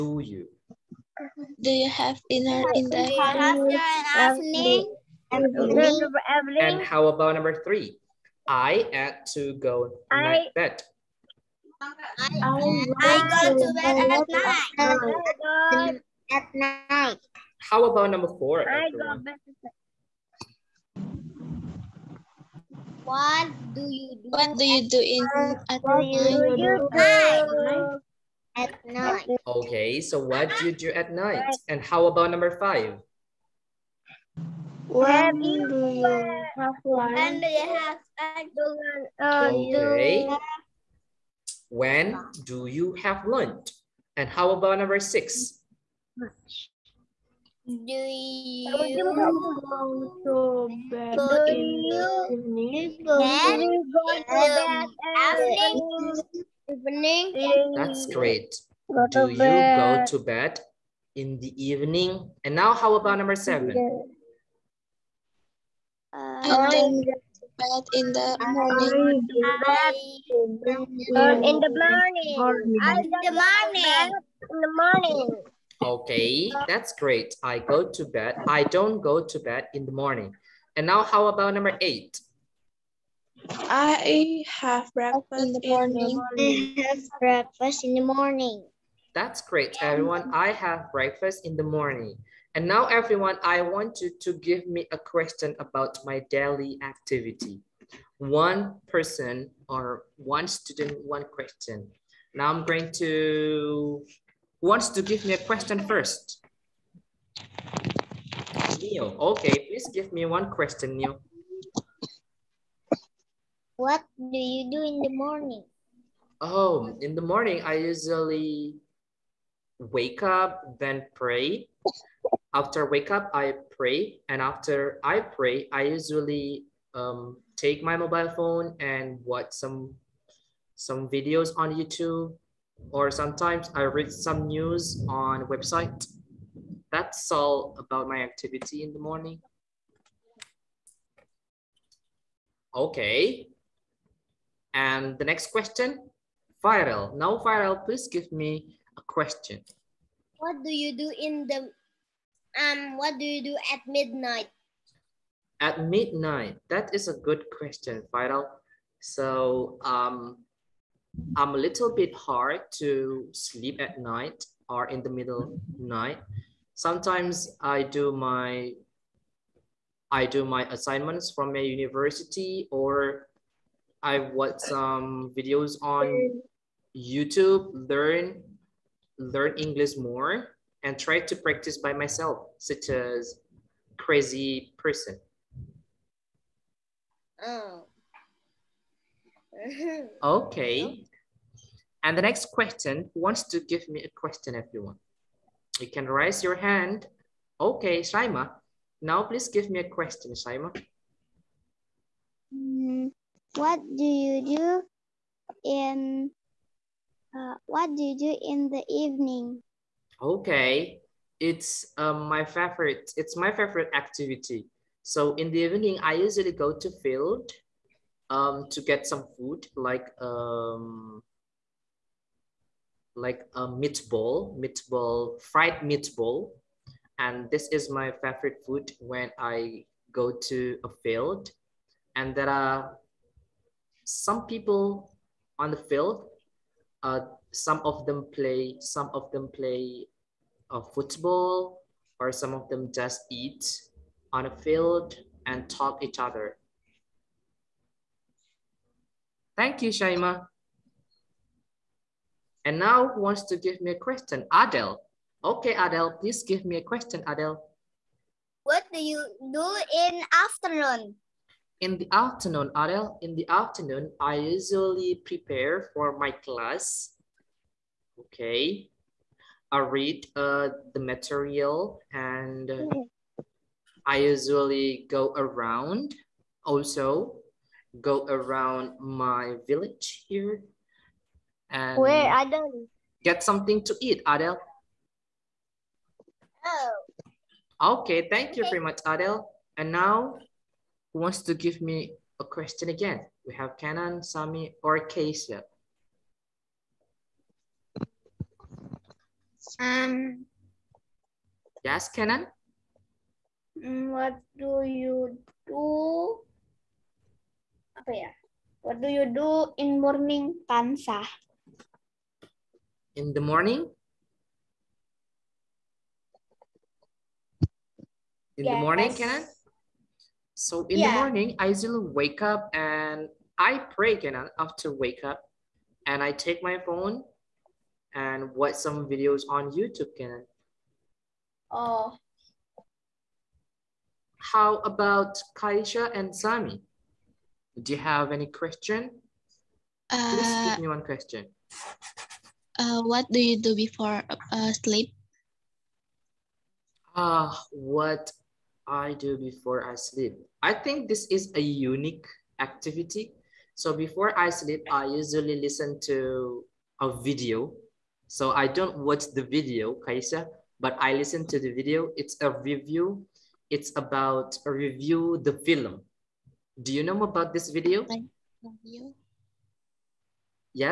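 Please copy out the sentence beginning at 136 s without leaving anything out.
That's all about my activity in the morning.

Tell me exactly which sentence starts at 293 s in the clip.
We have Kenan, Sami, or Kasia.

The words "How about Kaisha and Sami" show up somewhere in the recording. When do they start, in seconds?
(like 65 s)
334 s.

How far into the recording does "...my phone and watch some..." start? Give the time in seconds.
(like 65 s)
326 s.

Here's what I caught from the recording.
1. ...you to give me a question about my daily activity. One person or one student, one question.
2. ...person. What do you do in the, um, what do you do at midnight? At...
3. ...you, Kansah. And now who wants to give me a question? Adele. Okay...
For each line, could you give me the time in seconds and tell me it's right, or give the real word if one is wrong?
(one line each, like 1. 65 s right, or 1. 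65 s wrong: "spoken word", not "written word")
1. 94 s right
2. 149 s wrong: "question", not "person"
3. 249 s wrong: "Shaima", not "Kansah".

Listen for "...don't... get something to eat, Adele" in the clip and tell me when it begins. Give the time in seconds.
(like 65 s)
282 s.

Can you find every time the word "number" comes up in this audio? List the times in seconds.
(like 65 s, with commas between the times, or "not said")
7 s, 18 s, 32 s, 44 s, 63 s, 81 s.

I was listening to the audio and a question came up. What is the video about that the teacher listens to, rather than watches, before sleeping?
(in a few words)
film.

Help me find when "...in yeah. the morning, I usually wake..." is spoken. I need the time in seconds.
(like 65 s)
320 s.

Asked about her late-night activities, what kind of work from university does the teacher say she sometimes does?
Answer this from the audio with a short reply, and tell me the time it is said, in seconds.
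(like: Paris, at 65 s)
assignments, at 170 s.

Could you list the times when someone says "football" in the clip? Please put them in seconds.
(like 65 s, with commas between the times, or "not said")
240 s.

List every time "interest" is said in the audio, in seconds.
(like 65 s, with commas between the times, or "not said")
not said.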